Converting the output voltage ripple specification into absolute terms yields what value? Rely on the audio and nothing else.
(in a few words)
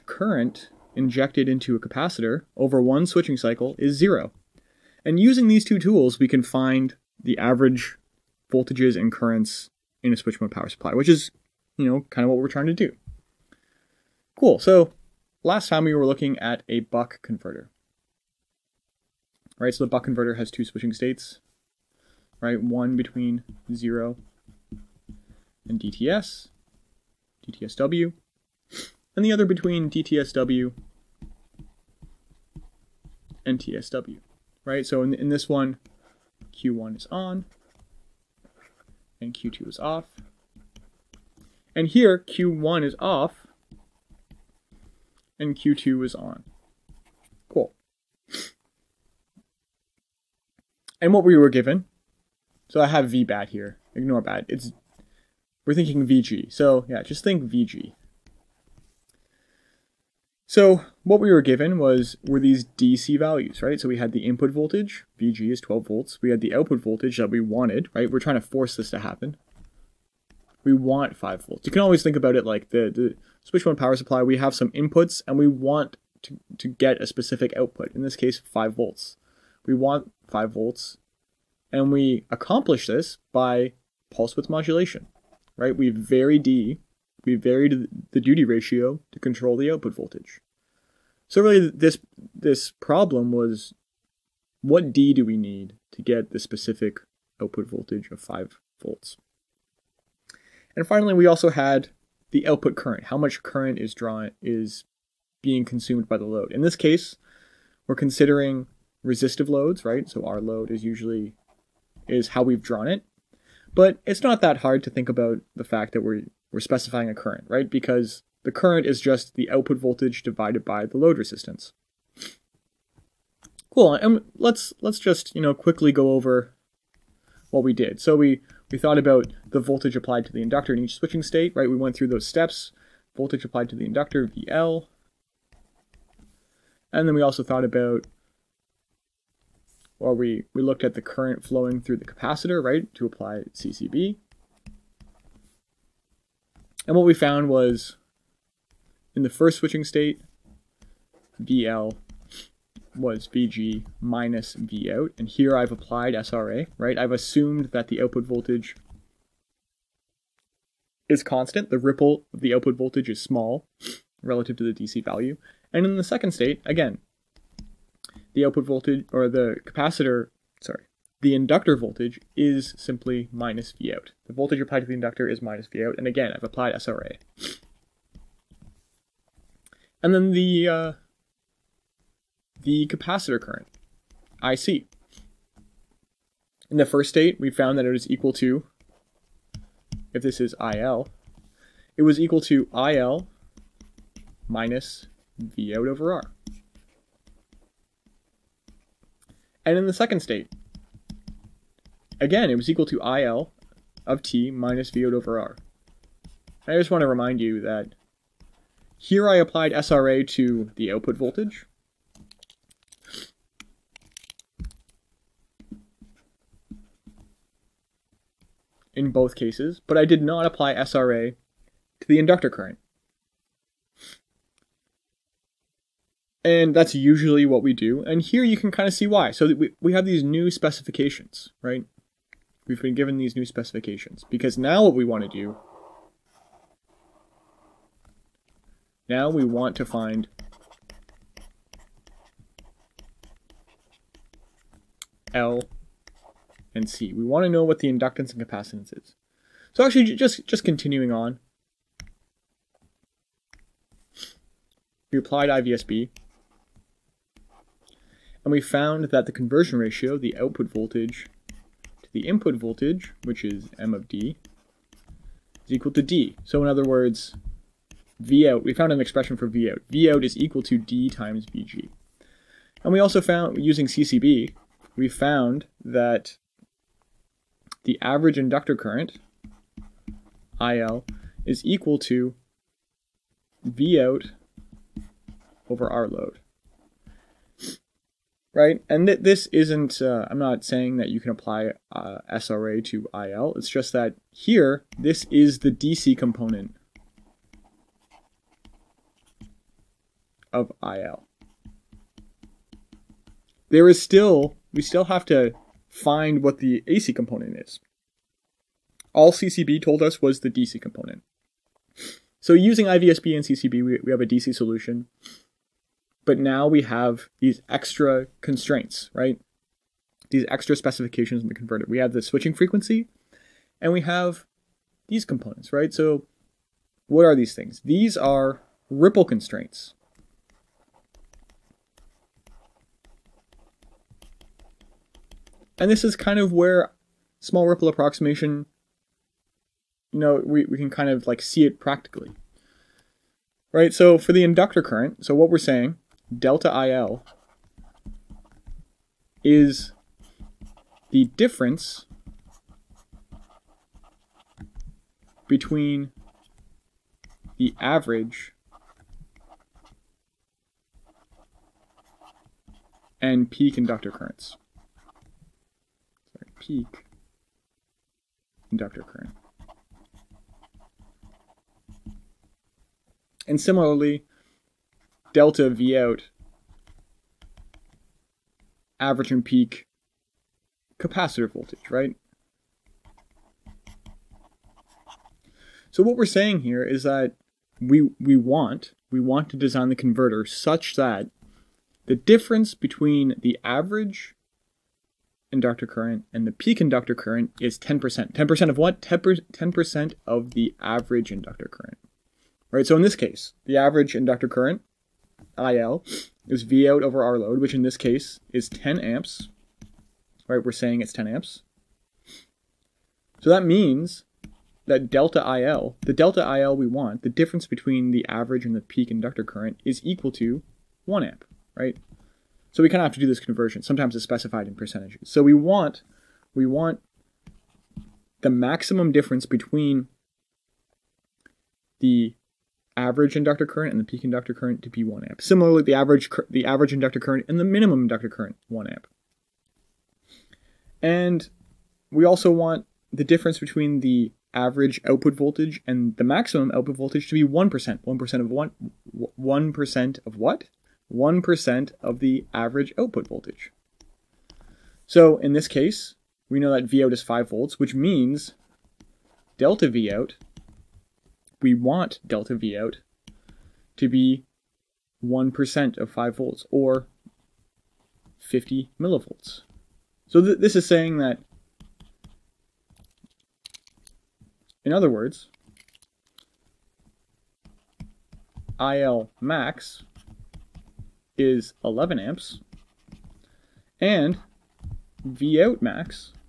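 50 millivolts.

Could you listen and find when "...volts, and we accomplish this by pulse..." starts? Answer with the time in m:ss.
1:20.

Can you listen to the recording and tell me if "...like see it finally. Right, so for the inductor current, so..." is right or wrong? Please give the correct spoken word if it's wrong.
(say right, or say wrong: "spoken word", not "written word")
wrong: "practically", not "finally".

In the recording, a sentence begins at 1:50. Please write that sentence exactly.
So our load is usually is how we've drawn it.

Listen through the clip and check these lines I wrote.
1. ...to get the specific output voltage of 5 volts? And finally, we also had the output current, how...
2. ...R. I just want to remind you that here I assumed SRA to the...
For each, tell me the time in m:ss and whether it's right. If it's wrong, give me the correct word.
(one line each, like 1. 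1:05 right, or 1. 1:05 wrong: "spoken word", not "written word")
1. 1:35 right
2. 3:25 wrong: "applied", not "assumed".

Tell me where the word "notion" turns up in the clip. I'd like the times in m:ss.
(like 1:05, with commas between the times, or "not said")
not said.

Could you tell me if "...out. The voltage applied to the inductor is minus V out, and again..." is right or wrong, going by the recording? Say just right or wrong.
right.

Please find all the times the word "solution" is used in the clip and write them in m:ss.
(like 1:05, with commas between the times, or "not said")
5:14.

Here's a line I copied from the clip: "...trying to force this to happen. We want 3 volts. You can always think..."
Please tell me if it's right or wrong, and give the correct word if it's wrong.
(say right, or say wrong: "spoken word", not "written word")
wrong: "5", not "3".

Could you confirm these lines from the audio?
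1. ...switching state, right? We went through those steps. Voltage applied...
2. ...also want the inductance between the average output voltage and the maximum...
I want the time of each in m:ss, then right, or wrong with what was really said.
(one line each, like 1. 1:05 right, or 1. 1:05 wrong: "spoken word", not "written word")
1. 2:10 right
2. 7:22 wrong: "difference", not "inductance".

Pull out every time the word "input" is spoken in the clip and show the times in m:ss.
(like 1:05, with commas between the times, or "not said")
1:04, 1:14, 4:22.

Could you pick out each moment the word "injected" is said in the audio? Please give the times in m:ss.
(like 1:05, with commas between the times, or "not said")
0:00.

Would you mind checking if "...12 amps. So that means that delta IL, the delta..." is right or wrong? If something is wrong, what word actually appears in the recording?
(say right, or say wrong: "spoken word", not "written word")
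wrong: "10", not "12".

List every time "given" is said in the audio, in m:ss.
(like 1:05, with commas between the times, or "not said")
0:51, 1:01, 3:52.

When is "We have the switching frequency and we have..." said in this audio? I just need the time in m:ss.
5:21.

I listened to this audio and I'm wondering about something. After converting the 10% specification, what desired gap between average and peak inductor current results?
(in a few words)
1 amp.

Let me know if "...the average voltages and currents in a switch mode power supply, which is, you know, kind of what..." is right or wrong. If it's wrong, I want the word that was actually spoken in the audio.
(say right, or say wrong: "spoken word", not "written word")
right.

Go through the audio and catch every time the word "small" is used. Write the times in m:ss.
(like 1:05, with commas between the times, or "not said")
2:43, 5:37.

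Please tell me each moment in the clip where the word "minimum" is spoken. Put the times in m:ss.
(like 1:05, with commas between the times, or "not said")
7:17.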